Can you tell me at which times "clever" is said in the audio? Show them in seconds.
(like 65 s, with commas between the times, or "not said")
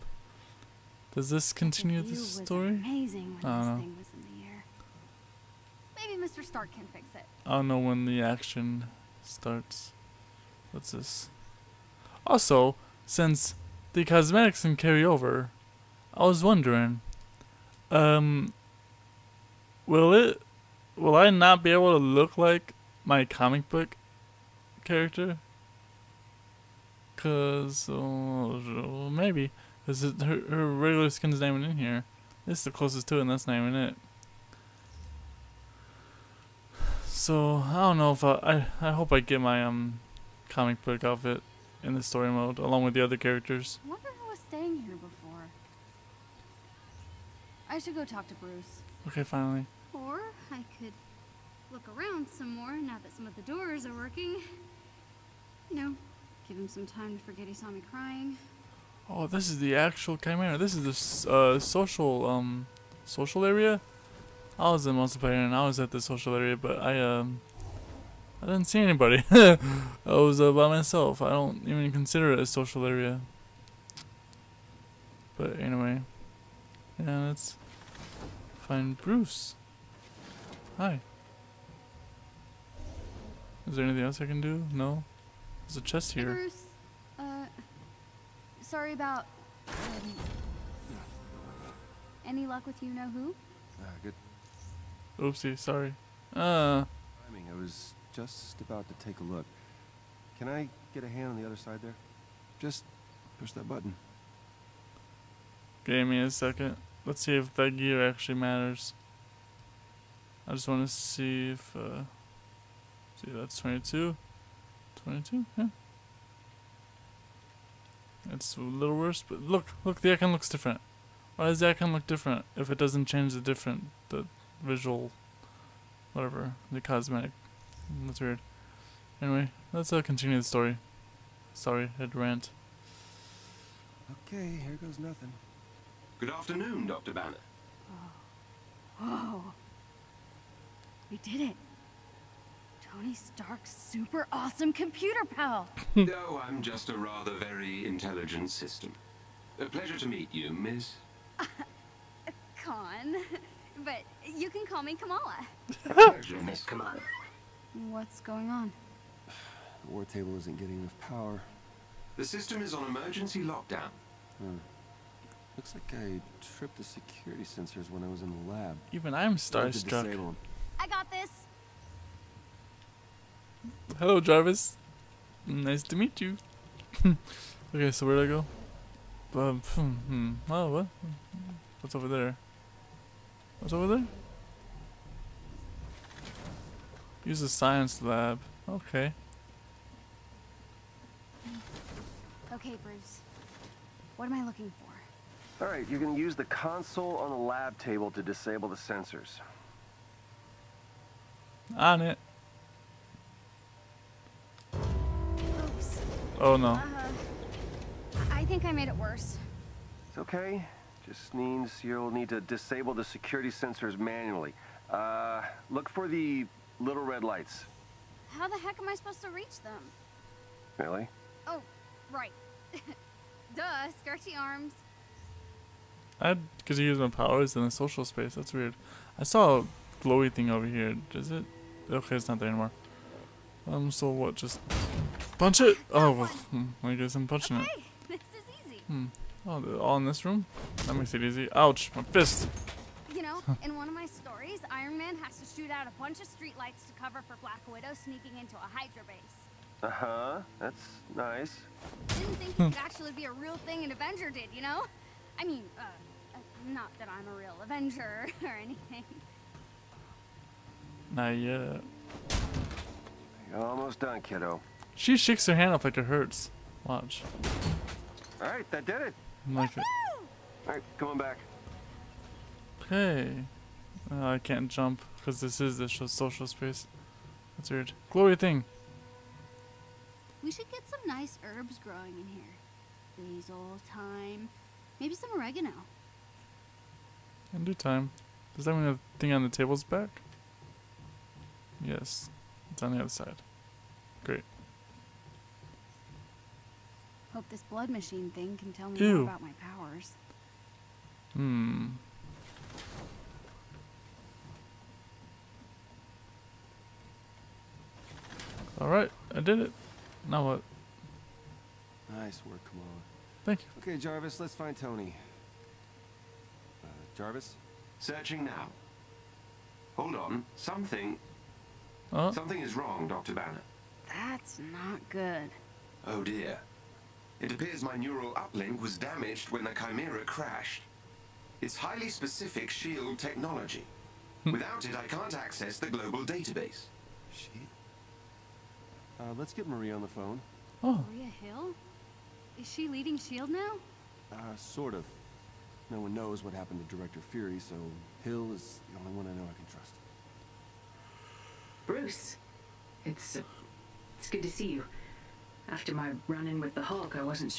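not said.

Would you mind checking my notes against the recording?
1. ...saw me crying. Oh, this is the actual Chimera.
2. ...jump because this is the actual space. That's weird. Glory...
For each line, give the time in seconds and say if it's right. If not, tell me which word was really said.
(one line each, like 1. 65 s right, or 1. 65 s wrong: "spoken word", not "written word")
1. 57 s right
2. 274 s wrong: "social", not "actual".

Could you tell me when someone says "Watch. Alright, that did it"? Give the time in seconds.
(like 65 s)
266 s.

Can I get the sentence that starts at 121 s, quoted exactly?
Why does the icon look different if it doesn't change the different, the visual, whatever, the cosmetic?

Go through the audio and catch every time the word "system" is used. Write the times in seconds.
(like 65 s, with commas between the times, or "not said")
148 s, 162 s.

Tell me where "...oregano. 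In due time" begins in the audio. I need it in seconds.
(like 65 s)
285 s.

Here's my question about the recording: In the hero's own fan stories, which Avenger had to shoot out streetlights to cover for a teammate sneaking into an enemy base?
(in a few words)
Iron Man.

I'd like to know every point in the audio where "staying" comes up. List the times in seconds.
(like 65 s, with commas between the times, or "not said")
44 s.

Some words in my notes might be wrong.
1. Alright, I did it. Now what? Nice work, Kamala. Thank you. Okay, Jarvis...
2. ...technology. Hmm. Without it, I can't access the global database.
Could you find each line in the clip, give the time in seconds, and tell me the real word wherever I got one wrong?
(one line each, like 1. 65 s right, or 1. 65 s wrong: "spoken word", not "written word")
1. 308 s right
2. 333 s right.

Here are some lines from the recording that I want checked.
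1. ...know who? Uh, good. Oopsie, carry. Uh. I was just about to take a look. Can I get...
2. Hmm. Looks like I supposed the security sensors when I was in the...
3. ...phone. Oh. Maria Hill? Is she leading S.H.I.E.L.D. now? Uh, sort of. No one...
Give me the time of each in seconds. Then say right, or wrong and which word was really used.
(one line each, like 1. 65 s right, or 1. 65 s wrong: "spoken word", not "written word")
1. 92 s wrong: "sorry", not "carry"
2. 164 s wrong: "tripped", not "supposed"
3. 340 s right.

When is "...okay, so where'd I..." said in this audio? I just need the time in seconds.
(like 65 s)
177 s.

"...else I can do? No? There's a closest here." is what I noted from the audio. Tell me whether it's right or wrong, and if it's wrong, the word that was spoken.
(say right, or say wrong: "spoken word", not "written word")
wrong: "chest", not "closest".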